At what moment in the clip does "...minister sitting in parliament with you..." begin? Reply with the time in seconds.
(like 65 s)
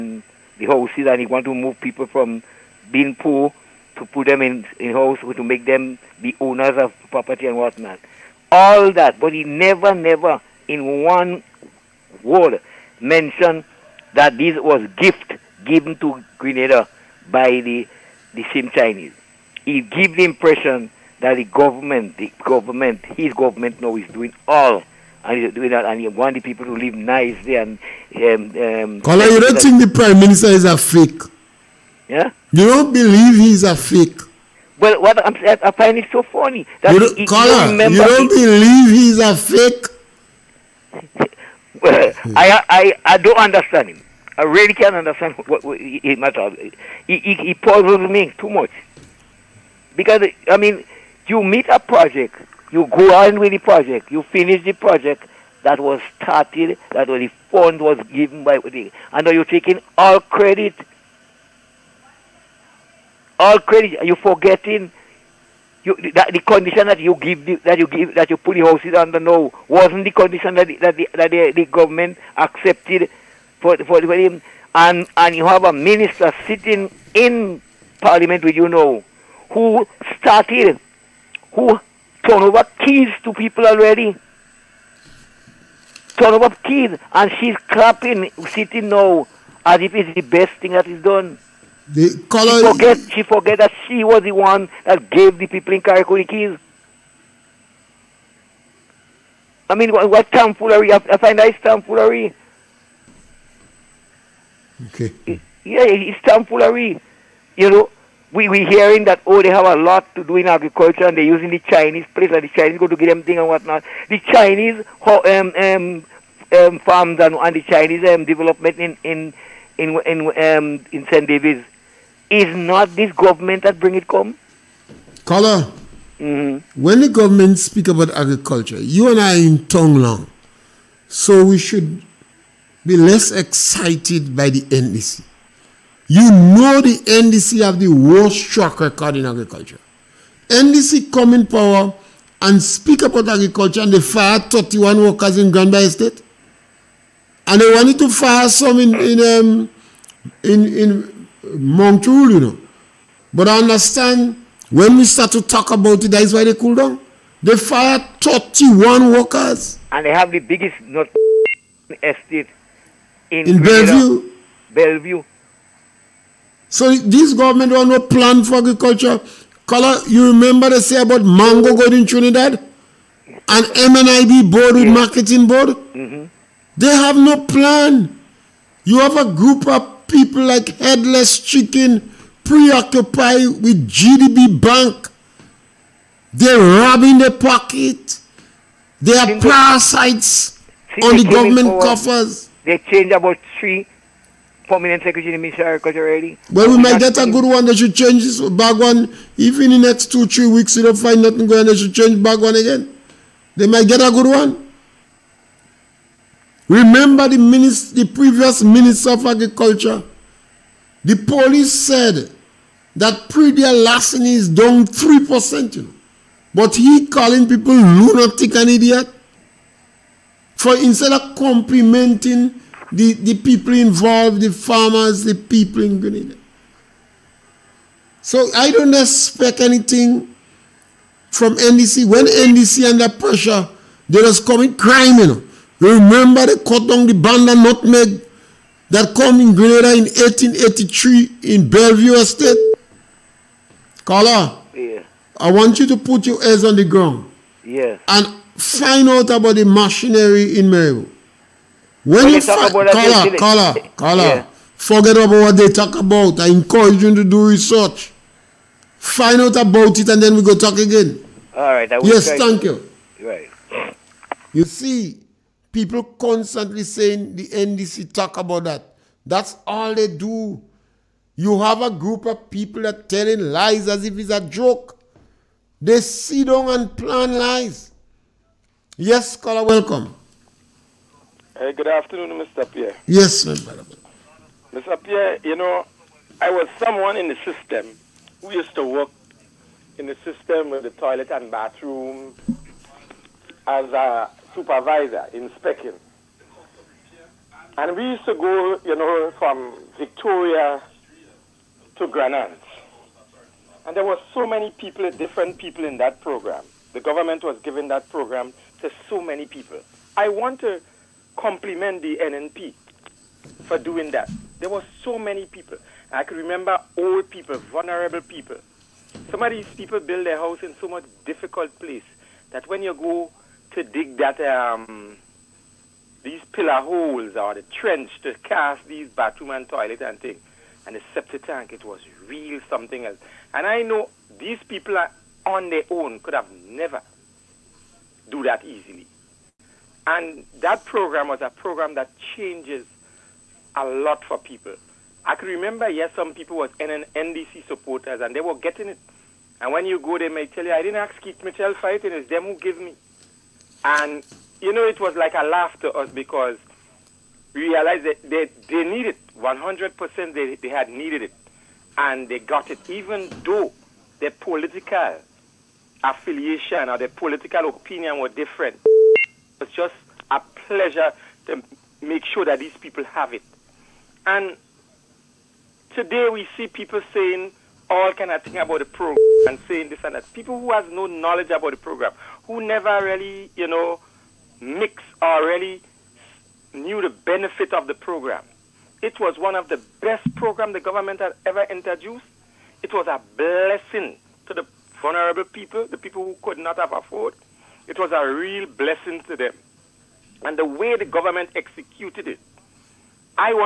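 75 s.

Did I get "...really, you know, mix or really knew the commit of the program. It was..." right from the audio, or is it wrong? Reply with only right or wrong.
wrong.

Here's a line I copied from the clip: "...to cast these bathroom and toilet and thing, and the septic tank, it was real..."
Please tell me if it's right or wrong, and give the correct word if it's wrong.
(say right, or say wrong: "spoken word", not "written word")
right.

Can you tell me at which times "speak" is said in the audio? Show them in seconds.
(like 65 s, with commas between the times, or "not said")
127 s, 142 s.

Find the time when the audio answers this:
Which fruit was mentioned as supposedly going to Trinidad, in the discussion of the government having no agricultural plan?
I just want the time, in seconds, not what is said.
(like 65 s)
171 s.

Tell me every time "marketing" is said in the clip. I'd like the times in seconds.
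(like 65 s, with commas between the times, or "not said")
174 s.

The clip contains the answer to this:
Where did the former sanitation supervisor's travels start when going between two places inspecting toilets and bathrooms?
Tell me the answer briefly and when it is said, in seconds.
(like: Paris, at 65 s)
Victoria, at 299 s.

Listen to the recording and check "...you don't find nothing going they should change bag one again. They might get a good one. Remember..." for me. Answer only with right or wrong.
right.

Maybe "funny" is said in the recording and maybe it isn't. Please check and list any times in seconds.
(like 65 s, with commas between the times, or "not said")
36 s.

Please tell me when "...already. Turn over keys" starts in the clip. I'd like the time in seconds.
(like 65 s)
83 s.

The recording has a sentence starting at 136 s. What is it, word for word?
You know the NDC have the worst track record in agriculture.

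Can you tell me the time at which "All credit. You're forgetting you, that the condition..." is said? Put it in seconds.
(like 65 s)
63 s.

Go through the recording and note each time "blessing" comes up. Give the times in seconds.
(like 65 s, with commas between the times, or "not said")
393 s, 398 s.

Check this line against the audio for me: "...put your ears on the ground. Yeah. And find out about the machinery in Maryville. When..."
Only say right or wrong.
right.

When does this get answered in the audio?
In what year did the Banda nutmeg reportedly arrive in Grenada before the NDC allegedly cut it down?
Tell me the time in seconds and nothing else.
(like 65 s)
240 s.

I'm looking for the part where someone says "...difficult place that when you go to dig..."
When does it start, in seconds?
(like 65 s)
321 s.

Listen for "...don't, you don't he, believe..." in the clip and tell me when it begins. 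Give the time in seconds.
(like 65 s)
37 s.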